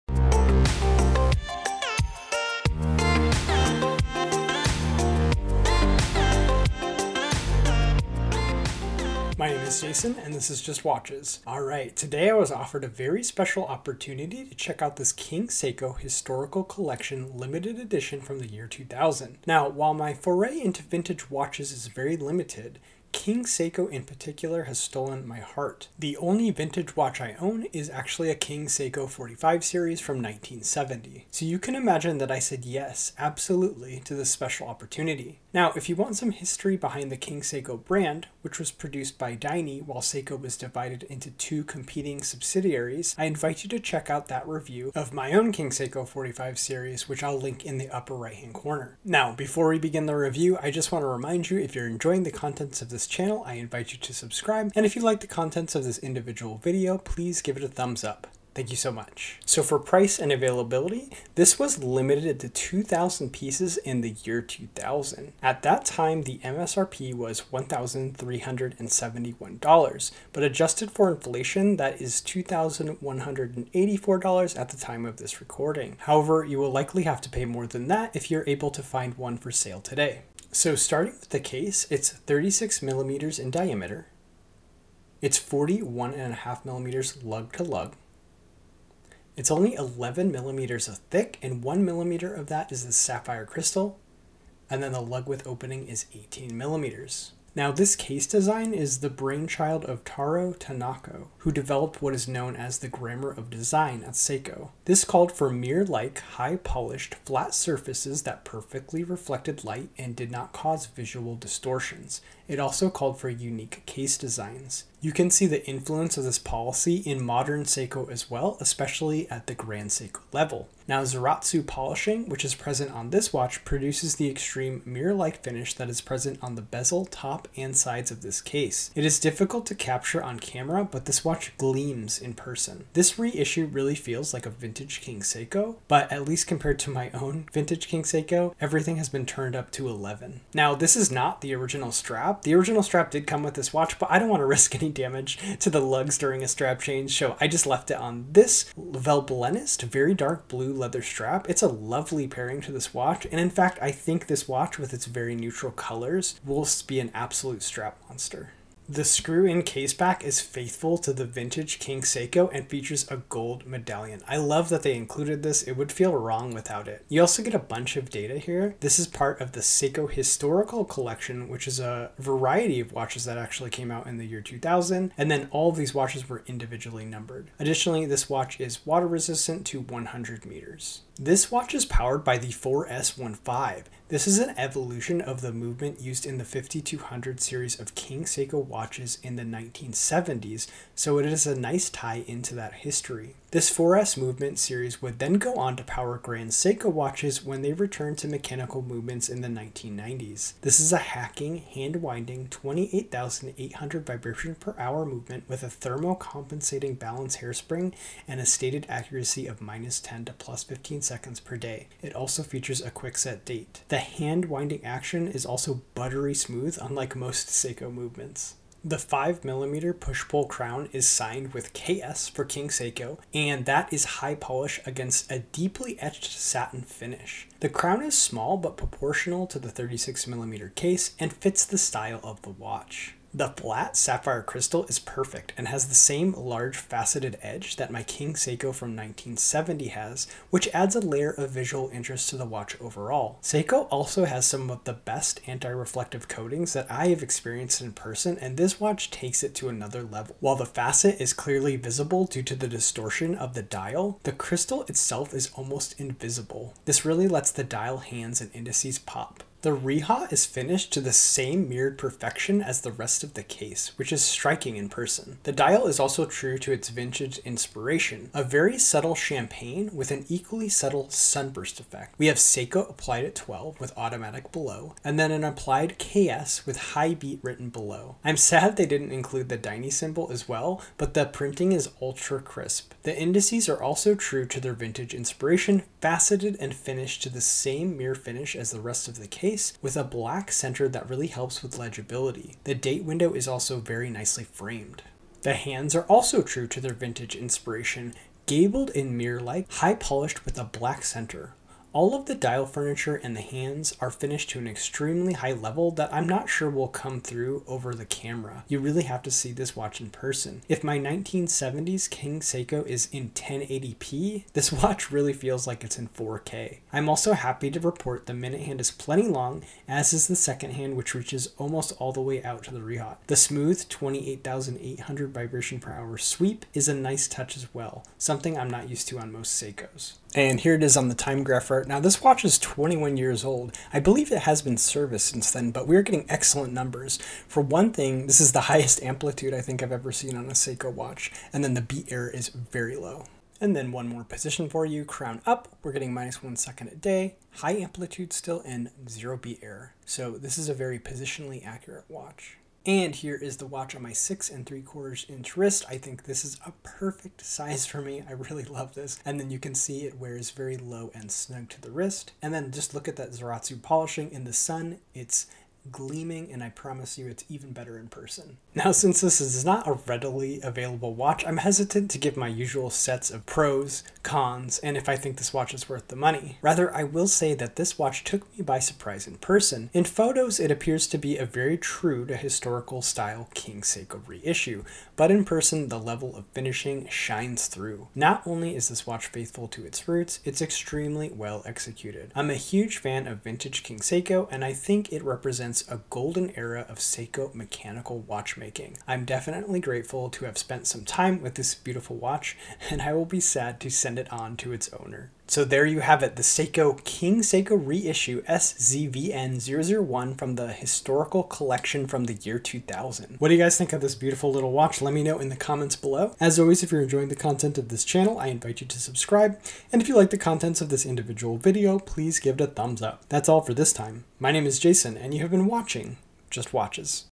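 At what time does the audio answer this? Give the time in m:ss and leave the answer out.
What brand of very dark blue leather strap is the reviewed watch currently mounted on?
2:28.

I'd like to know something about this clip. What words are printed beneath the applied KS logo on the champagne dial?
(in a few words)
high beat.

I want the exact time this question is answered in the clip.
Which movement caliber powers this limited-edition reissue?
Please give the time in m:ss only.
3:02.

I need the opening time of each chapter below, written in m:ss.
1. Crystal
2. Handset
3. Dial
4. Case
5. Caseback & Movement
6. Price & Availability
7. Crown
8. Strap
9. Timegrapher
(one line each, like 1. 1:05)
1. 3:53
2. 4:55
3. 4:19
4. 1:20
5. 2:39
6. 1:00
7. 3:38
8. 2:20
9. 5:30.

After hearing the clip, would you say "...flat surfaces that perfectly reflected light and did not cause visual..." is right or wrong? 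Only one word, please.
right.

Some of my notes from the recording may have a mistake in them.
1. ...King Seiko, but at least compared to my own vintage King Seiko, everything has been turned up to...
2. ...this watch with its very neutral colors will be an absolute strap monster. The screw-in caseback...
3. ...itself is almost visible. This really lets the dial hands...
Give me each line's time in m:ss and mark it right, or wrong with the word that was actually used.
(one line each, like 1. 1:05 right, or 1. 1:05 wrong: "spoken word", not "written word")
1. 2:15 right
2. 2:34 right
3. 4:14 wrong: "invisible", not "visible".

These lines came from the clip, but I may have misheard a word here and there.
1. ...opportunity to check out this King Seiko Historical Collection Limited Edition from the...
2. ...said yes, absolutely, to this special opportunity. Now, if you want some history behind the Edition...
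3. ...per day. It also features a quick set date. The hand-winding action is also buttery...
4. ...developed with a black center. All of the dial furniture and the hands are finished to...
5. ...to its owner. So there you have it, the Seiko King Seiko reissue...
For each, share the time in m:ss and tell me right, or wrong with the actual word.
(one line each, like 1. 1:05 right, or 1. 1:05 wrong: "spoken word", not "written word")
1. 0:13 right
2. 0:32 wrong: "King", not "Edition"
3. 3:31 right
4. 4:59 wrong: "polished", not "developed"
5. 6:44 right.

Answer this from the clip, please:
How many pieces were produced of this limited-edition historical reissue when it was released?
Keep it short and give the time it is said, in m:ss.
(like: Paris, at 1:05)
2,000, at 1:02.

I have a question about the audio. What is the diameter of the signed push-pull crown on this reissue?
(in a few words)
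5mm.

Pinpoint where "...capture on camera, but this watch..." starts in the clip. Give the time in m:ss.
2:09.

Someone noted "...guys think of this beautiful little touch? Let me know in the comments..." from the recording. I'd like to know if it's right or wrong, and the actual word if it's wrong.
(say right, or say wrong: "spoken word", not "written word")
wrong: "watch", not "touch".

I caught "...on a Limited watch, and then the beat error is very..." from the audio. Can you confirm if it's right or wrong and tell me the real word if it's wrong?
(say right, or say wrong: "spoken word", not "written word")
wrong: "Seiko", not "Limited".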